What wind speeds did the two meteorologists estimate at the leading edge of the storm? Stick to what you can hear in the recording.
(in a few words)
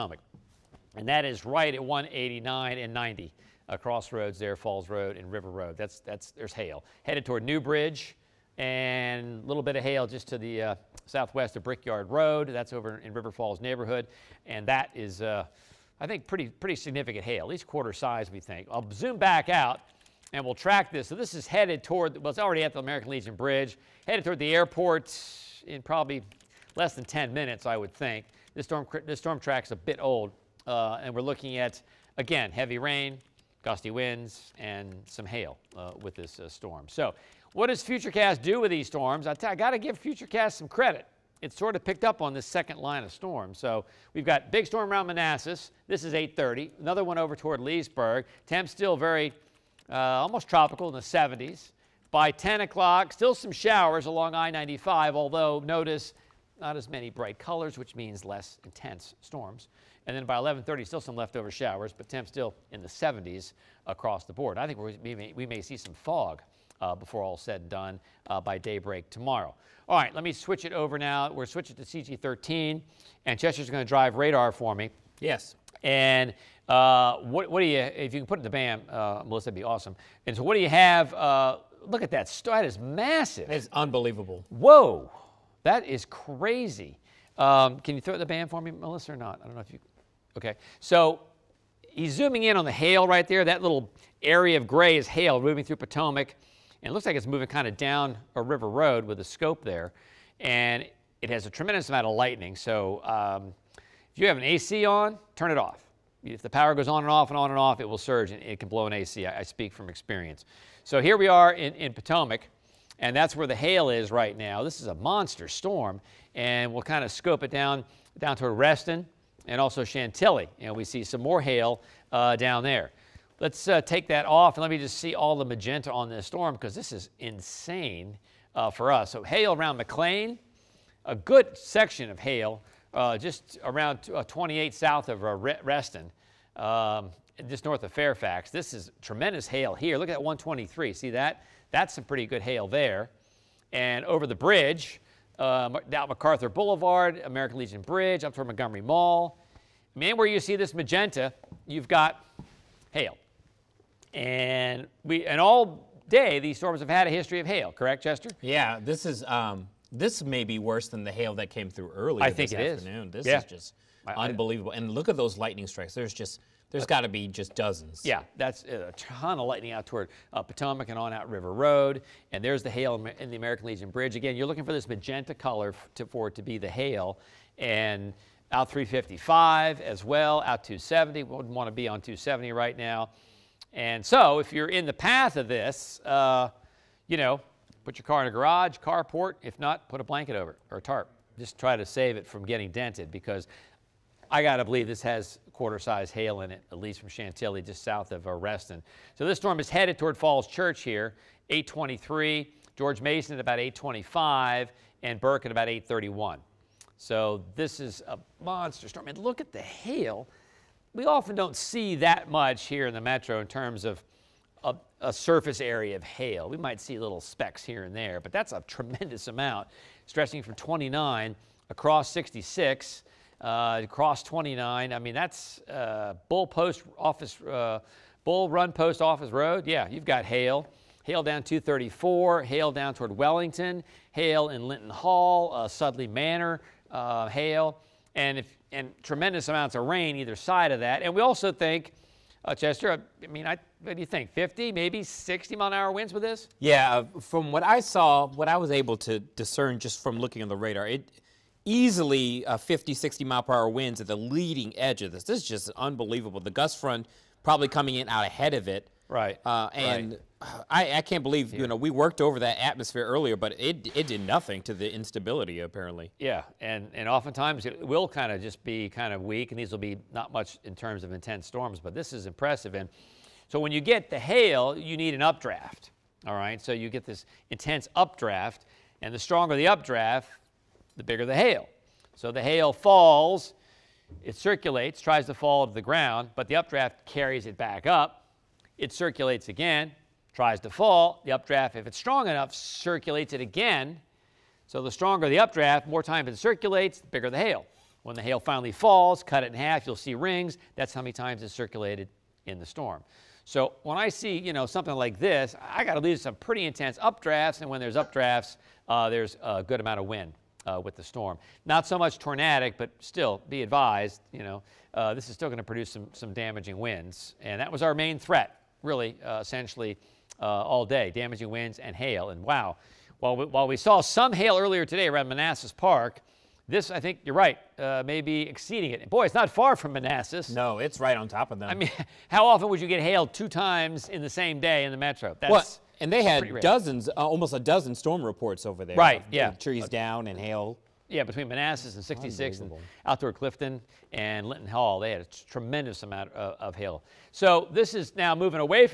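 50 to 60 mph.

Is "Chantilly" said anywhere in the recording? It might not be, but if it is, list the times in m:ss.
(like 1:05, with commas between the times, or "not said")
1:59, 3:17.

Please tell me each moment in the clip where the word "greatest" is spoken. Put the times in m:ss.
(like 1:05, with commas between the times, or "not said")
not said.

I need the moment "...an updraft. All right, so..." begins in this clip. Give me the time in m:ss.
4:35.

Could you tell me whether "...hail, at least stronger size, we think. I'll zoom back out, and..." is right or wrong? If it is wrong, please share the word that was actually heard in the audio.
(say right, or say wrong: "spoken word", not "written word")
wrong: "quarter", not "stronger".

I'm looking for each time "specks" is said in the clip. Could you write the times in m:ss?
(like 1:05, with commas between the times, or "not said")
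3:37.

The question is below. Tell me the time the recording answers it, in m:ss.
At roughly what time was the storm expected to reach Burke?
3:25.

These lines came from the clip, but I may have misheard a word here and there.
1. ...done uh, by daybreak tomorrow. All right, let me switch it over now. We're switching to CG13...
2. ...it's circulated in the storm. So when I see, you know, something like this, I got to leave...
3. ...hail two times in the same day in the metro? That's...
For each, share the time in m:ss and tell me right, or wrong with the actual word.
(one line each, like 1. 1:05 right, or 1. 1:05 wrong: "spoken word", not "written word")
1. 1:07 right
2. 5:01 right
3. 5:33 right.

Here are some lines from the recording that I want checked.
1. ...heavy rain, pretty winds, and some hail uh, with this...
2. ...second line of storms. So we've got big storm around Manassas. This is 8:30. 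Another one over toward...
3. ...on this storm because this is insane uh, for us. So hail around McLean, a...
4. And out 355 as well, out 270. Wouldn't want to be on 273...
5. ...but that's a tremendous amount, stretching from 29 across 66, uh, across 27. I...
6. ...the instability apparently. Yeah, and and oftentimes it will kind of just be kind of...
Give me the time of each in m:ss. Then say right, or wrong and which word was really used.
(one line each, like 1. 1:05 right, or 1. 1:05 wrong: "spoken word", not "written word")
1. 0:32 wrong: "gusty", not "pretty"
2. 0:42 right
3. 2:05 right
4. 2:57 wrong: "270", not "273"
5. 3:38 wrong: "29", not "27"
6. 4:24 right.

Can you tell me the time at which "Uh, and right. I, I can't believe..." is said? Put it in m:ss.
4:19.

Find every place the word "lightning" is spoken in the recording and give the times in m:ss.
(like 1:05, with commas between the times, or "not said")
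1:42, 2:45, 2:49.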